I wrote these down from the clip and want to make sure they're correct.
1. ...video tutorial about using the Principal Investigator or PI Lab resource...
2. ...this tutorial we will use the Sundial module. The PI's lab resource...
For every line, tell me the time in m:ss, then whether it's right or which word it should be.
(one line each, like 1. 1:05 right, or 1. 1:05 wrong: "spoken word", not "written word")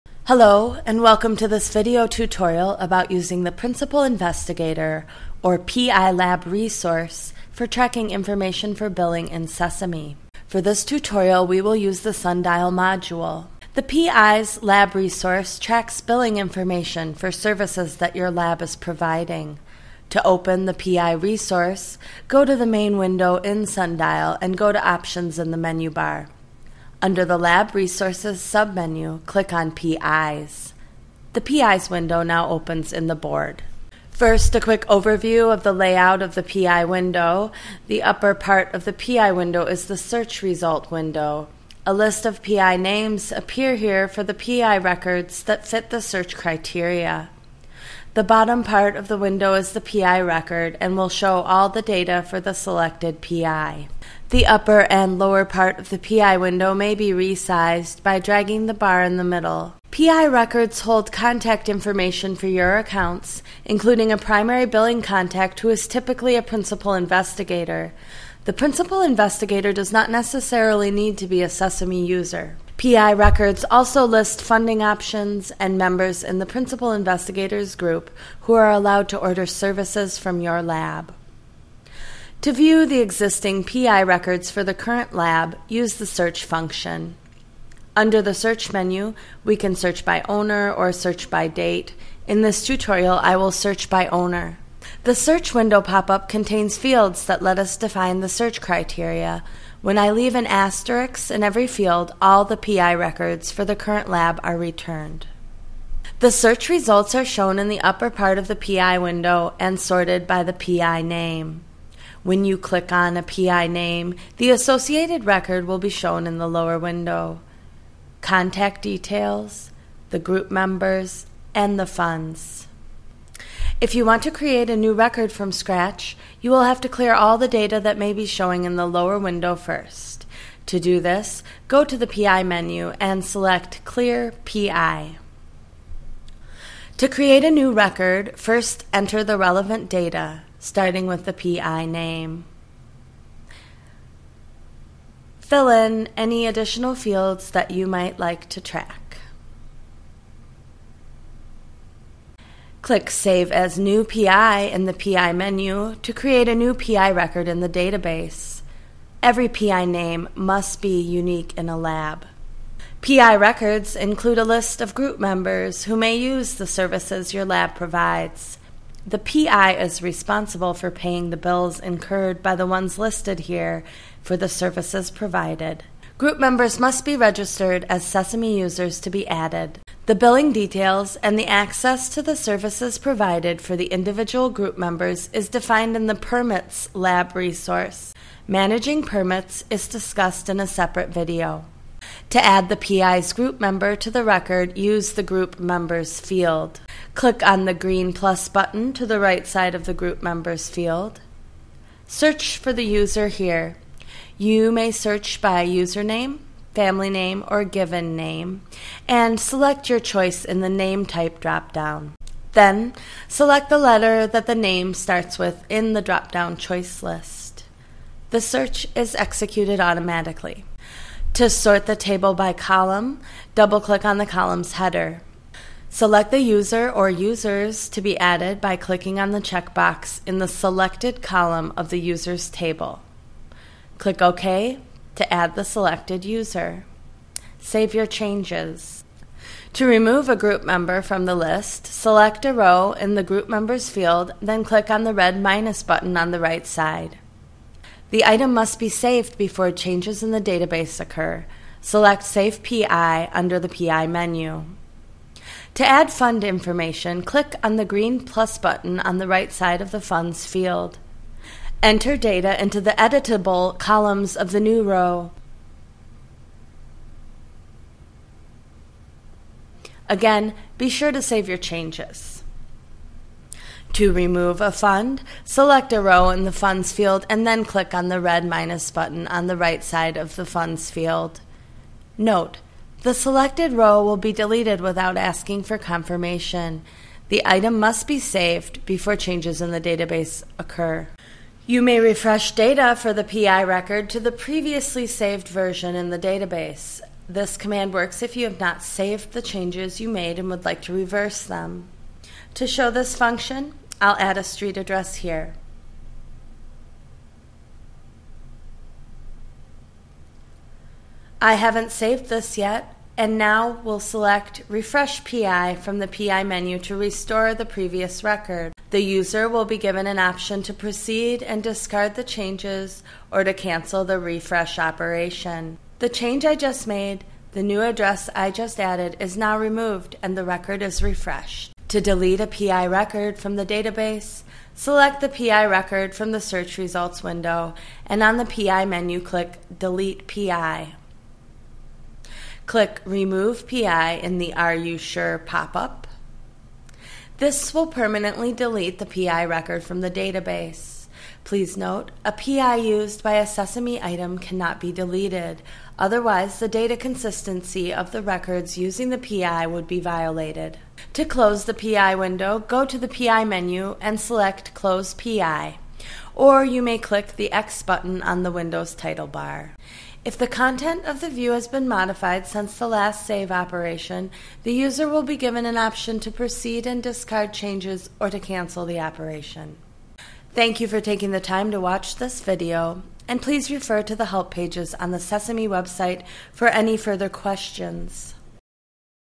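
1. 0:01 right
2. 0:10 right.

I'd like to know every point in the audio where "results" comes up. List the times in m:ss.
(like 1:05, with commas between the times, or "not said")
0:40, 1:46, 5:36.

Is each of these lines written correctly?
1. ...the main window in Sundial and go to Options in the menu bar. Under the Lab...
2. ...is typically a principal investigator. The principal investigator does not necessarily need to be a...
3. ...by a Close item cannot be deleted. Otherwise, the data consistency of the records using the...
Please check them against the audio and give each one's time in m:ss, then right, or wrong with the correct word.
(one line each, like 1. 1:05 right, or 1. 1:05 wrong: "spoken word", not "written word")
1. 0:22 right
2. 1:05 right
3. 5:53 wrong: "Sesame", not "Close".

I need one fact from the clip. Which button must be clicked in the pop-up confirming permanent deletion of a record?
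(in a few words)
Remove PI.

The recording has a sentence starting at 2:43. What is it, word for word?
PI records include a list of group members who may use the services your lab provides.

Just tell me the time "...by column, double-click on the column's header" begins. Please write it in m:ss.
3:42.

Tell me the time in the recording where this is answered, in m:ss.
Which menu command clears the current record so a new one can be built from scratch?
2:13.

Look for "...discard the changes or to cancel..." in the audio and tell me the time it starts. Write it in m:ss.
5:21.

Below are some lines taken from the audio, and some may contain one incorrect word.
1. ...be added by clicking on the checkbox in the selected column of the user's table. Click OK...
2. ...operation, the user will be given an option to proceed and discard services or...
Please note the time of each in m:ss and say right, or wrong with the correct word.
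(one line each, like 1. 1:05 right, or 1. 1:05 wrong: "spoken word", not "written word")
1. 3:48 right
2. 6:13 wrong: "changes", not "services".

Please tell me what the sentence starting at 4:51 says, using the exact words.
You may refresh data for the PI record to the previously saved version in the database.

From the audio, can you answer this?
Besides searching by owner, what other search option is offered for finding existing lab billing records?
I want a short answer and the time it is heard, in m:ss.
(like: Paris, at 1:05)
Search by date, at 1:30.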